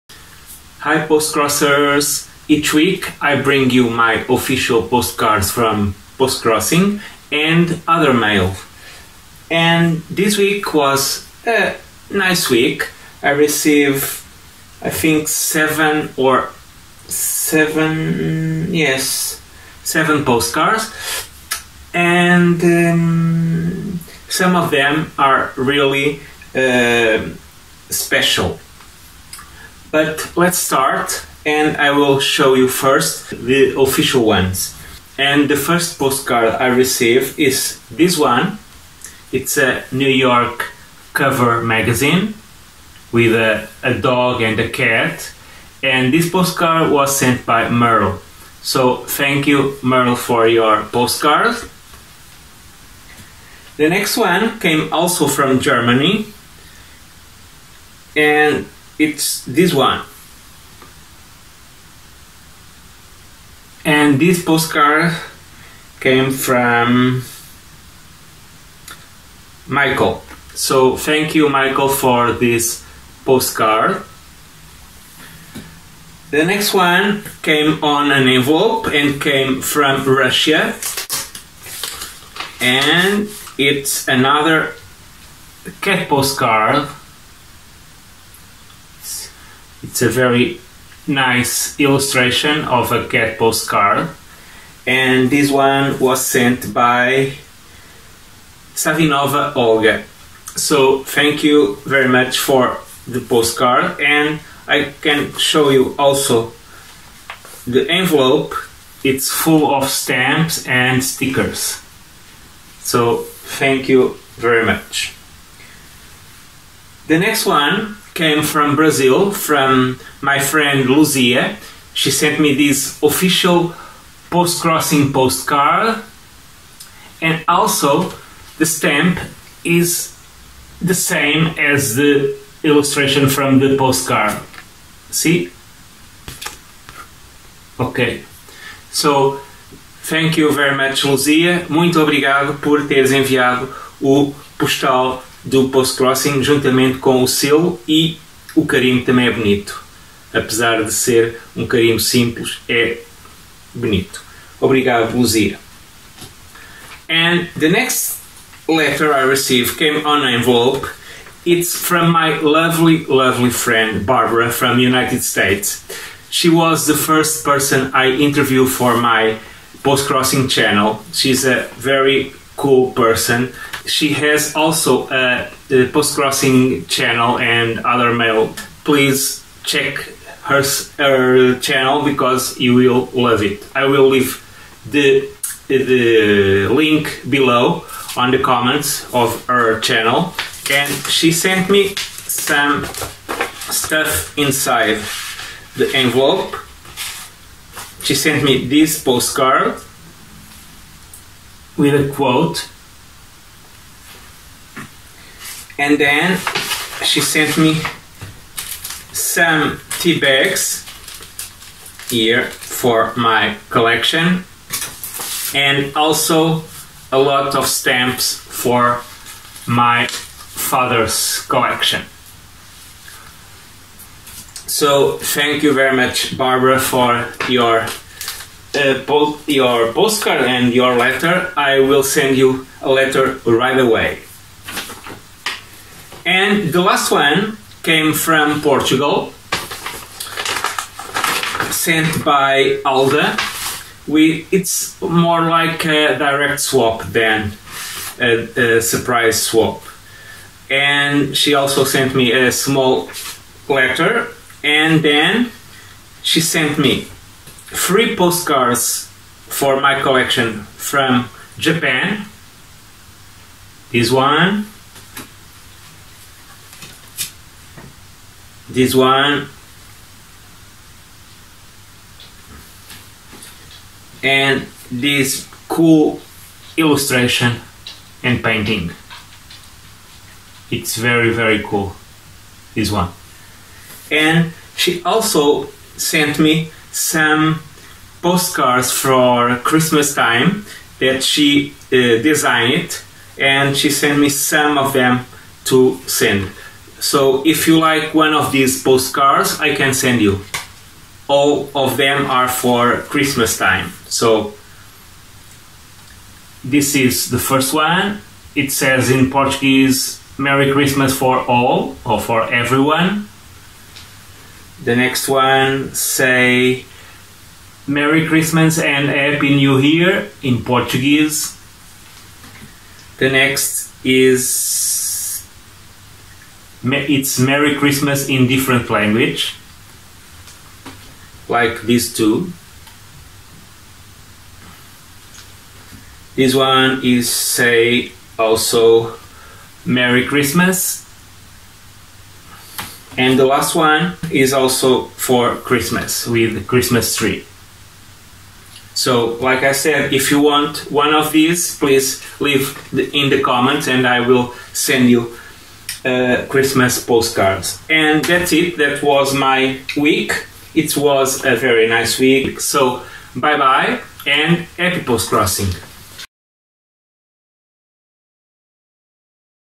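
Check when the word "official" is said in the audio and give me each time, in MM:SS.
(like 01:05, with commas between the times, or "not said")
00:04, 00:33, 02:03.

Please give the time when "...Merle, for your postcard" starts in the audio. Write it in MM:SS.
00:49.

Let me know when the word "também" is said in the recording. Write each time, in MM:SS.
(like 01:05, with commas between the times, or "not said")
02:29.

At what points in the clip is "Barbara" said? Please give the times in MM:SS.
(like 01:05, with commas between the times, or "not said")
02:44, 03:46.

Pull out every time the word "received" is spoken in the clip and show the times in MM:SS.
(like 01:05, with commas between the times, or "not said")
00:13, 00:36, 02:39.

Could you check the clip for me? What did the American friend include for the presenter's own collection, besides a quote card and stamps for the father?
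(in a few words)
tea bags.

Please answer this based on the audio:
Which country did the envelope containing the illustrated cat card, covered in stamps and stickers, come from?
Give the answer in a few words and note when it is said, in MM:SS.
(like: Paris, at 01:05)
Russia, at 01:20.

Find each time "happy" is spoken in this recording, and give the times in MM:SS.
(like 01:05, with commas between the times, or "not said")
05:19, 06:04.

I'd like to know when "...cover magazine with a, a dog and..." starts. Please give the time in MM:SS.
00:41.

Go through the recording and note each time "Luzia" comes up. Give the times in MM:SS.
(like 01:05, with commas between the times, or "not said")
02:00, 02:21, 02:35.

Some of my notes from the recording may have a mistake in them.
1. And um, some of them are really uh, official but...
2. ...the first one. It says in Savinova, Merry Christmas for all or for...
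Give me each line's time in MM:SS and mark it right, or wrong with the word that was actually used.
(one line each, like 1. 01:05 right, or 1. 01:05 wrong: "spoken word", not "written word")
1. 00:21 wrong: "special", not "official"
2. 05:07 wrong: "Portuguese", not "Savinova".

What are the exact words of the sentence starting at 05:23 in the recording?
The next is it's Merry Christmas in different language, like these two.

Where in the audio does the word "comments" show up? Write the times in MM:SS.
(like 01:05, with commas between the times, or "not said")
03:08, 05:53.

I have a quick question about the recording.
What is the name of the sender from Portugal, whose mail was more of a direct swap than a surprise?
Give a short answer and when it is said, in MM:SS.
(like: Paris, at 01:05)
Alda, at 04:02.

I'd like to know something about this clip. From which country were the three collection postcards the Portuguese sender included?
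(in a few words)
Japan.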